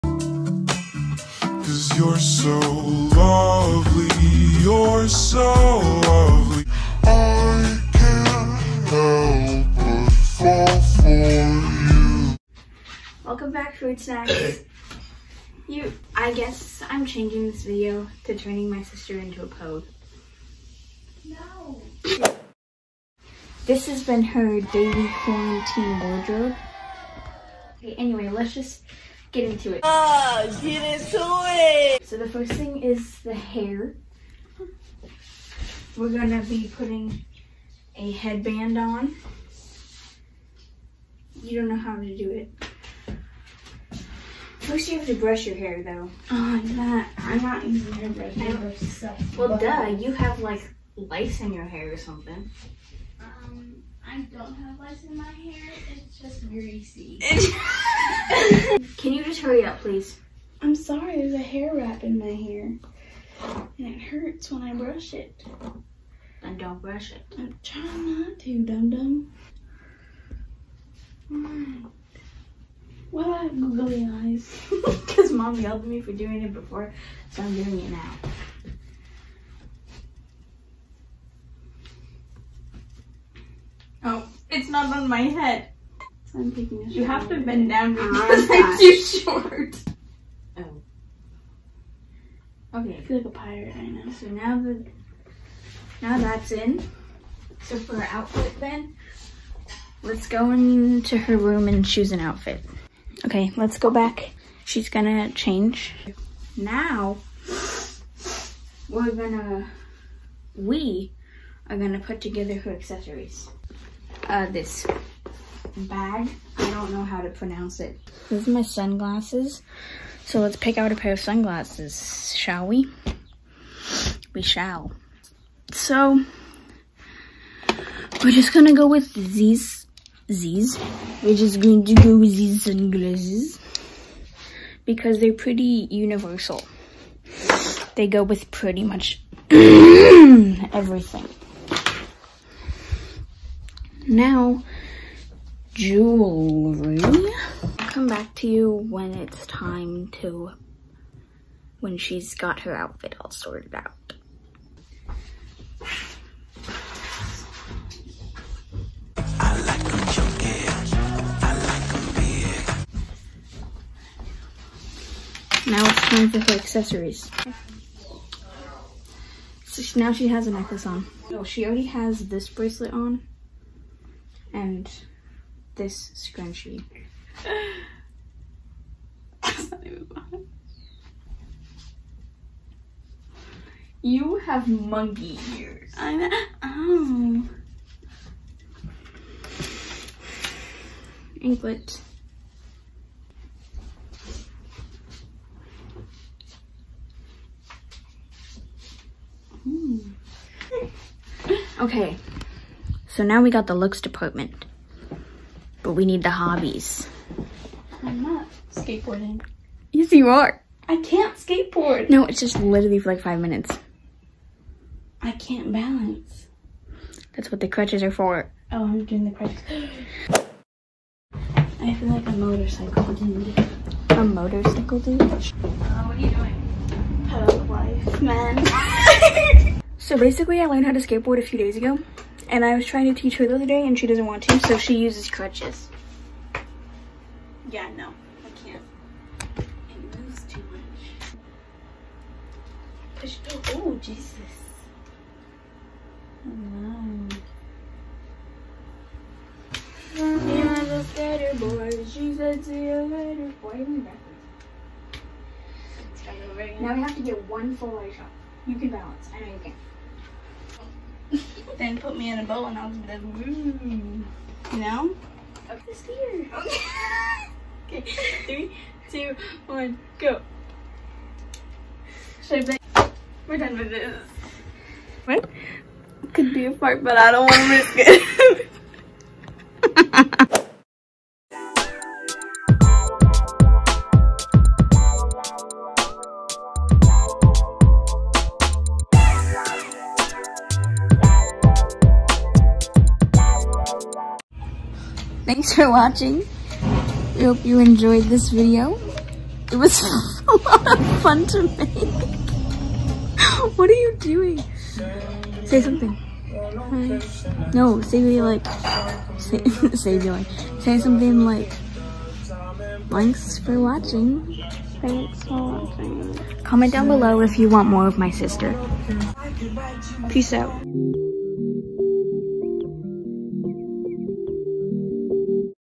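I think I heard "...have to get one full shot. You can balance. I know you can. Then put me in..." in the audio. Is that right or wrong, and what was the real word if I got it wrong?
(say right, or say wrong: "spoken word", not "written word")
right.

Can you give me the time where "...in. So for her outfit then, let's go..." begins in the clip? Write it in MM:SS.
01:36.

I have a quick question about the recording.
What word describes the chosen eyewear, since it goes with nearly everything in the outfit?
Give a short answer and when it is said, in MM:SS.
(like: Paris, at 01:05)
Universal, at 02:15.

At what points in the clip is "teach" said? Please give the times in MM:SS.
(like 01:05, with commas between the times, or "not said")
03:53.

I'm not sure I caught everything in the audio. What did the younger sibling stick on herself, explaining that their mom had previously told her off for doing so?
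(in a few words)
Googly eyes.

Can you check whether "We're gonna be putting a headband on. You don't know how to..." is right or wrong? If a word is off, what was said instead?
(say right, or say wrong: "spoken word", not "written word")
right.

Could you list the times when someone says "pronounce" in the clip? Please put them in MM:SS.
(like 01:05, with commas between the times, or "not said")
01:57.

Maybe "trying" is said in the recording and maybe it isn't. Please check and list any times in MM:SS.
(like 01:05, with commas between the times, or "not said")
01:07, 03:52.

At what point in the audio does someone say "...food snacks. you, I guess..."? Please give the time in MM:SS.
00:13.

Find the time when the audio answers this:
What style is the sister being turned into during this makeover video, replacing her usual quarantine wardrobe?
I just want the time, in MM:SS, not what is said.
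00:19.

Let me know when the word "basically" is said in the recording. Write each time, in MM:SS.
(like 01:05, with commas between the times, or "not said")
03:50.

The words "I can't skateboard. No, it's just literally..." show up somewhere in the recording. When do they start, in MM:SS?
03:30.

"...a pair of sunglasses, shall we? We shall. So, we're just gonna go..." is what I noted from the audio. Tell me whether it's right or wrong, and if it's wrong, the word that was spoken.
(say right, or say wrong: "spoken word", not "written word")
right.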